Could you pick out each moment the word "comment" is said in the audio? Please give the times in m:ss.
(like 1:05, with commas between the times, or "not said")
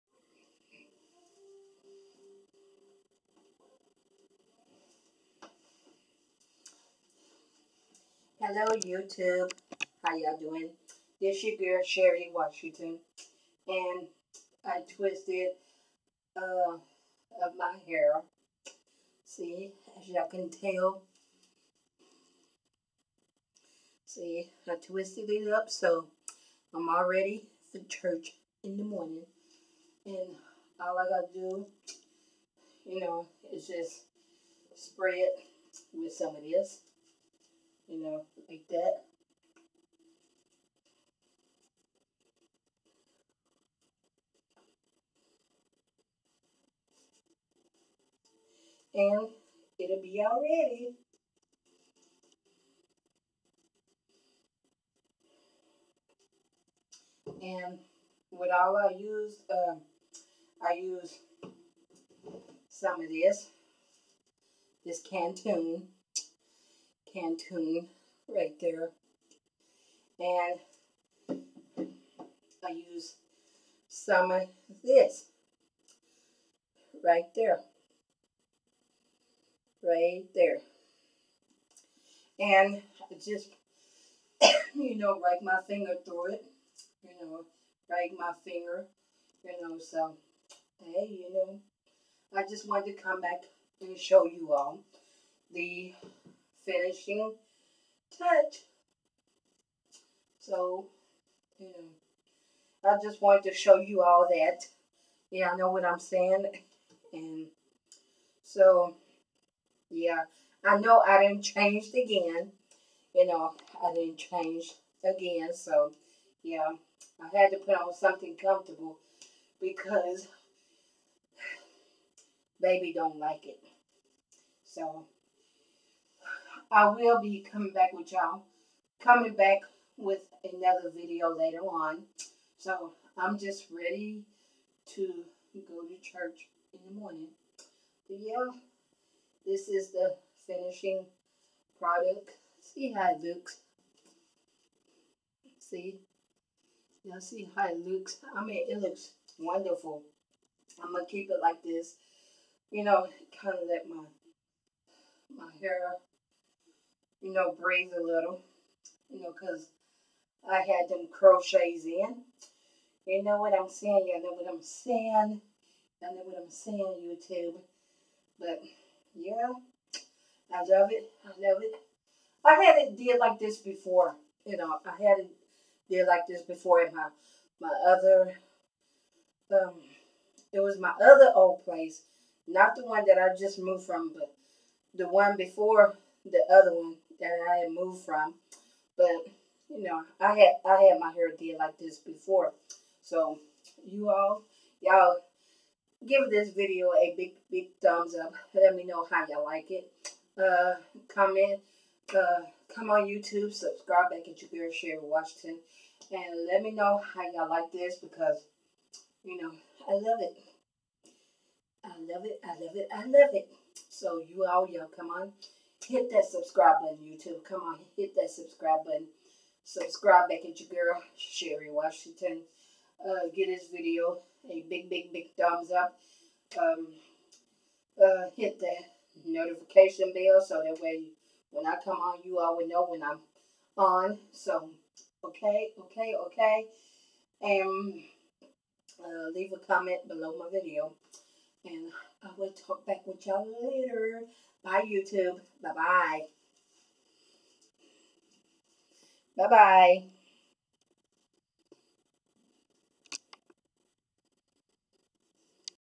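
3:21, 3:59.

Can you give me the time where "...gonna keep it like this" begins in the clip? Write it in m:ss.
2:30.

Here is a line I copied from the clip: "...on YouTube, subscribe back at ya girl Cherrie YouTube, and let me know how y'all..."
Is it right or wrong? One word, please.
wrong.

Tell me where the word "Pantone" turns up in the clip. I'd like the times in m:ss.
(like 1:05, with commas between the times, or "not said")
1:07.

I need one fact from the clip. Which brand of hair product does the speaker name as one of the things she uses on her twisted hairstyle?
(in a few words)
Cantu.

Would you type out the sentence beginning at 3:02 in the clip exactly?
Not the one that I just moved from, but the one before the other one that I had moved from.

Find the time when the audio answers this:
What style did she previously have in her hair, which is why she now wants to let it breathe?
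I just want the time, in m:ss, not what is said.
2:41.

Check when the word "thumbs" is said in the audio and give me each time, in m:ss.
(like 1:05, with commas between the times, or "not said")
3:17, 3:45.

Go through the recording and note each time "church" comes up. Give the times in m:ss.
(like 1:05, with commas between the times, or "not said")
0:27, 2:16.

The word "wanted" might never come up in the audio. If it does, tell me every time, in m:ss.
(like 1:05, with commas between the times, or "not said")
1:32, 1:43.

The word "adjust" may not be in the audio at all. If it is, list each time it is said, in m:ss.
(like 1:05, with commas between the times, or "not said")
not said.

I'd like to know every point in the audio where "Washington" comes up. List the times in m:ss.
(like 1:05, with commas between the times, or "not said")
0:12, 3:25, 3:41.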